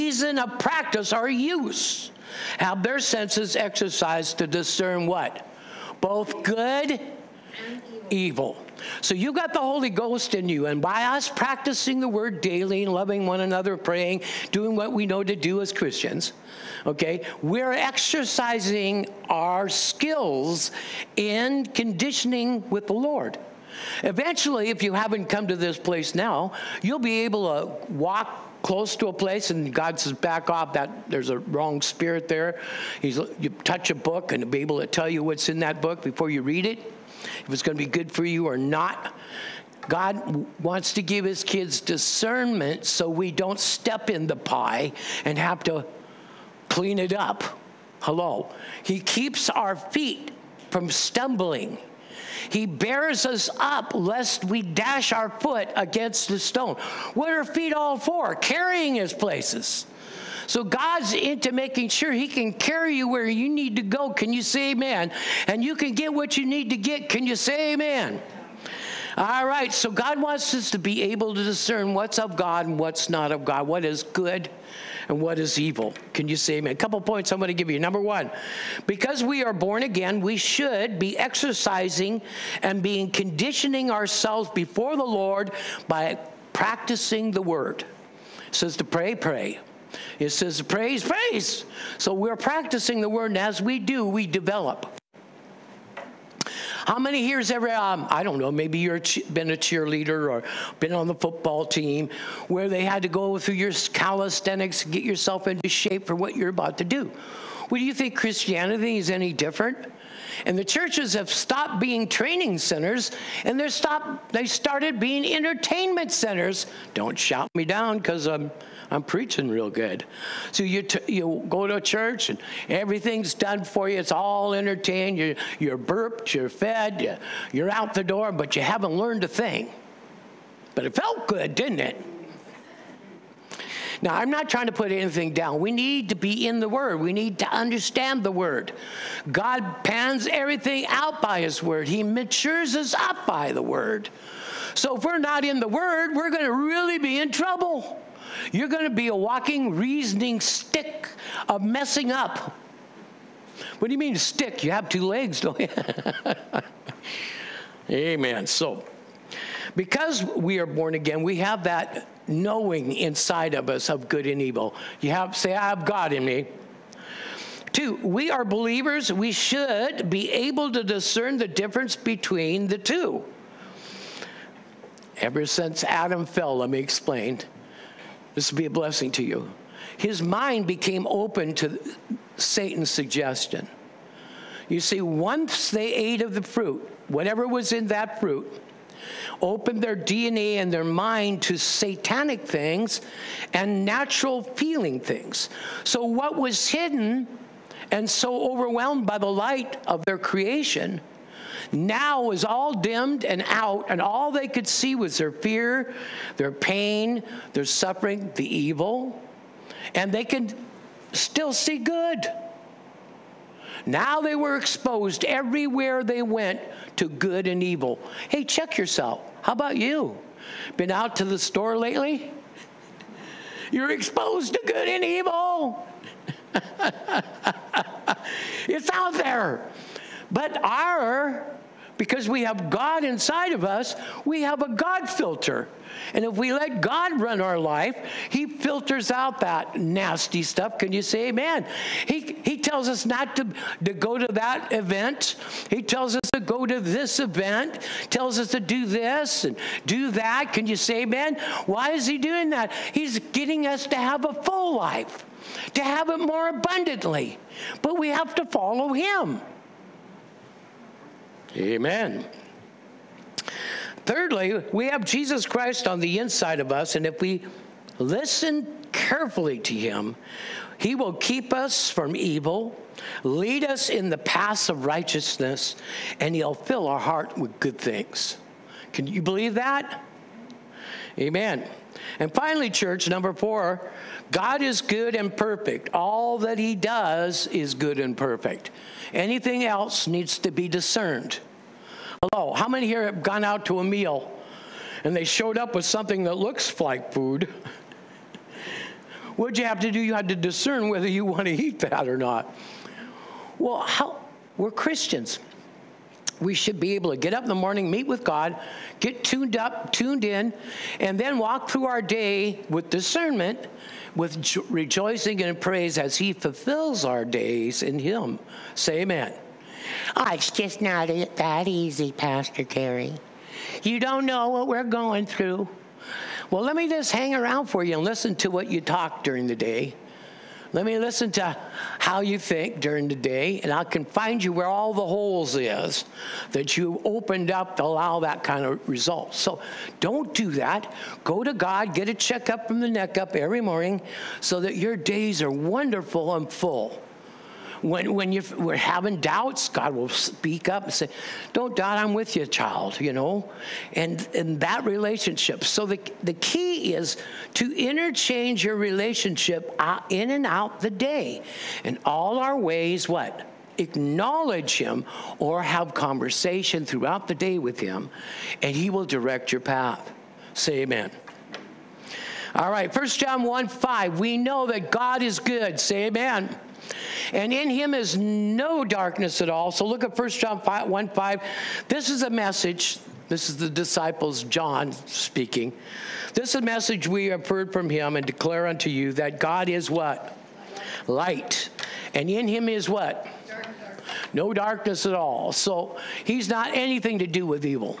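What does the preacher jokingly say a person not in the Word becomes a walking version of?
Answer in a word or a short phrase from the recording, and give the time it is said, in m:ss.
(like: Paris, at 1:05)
reasoning stick, at 2:29.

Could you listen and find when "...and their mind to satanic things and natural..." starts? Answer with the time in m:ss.
3:10.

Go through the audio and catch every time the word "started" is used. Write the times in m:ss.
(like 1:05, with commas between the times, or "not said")
1:54.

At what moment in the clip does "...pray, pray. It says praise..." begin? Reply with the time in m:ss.
1:28.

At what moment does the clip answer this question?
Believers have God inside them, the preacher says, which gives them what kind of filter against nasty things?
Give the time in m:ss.
3:54.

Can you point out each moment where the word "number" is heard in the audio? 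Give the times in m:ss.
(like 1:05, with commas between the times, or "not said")
1:17, 4:43.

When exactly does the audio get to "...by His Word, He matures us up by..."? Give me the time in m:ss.
2:21.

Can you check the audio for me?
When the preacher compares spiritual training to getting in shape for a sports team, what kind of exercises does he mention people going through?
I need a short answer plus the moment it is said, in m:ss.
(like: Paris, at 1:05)
calisthenics, at 1:43.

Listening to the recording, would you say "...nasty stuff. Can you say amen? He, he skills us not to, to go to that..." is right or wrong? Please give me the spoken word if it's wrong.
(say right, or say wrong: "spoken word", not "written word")
wrong: "tells", not "skills".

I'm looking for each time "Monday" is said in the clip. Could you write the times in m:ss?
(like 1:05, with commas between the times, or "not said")
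not said.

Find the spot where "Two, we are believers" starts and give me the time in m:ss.
2:47.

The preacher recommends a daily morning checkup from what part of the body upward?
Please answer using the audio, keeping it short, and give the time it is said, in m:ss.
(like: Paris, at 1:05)
the neck up, at 5:42.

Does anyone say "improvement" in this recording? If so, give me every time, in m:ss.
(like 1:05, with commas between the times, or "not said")
not said.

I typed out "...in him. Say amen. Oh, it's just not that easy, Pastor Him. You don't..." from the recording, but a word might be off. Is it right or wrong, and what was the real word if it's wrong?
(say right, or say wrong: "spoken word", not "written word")
wrong: "Kerry", not "Him".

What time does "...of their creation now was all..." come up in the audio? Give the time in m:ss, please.
3:19.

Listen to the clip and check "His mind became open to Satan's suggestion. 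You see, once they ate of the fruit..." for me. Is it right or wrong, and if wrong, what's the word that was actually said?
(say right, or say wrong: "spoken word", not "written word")
right.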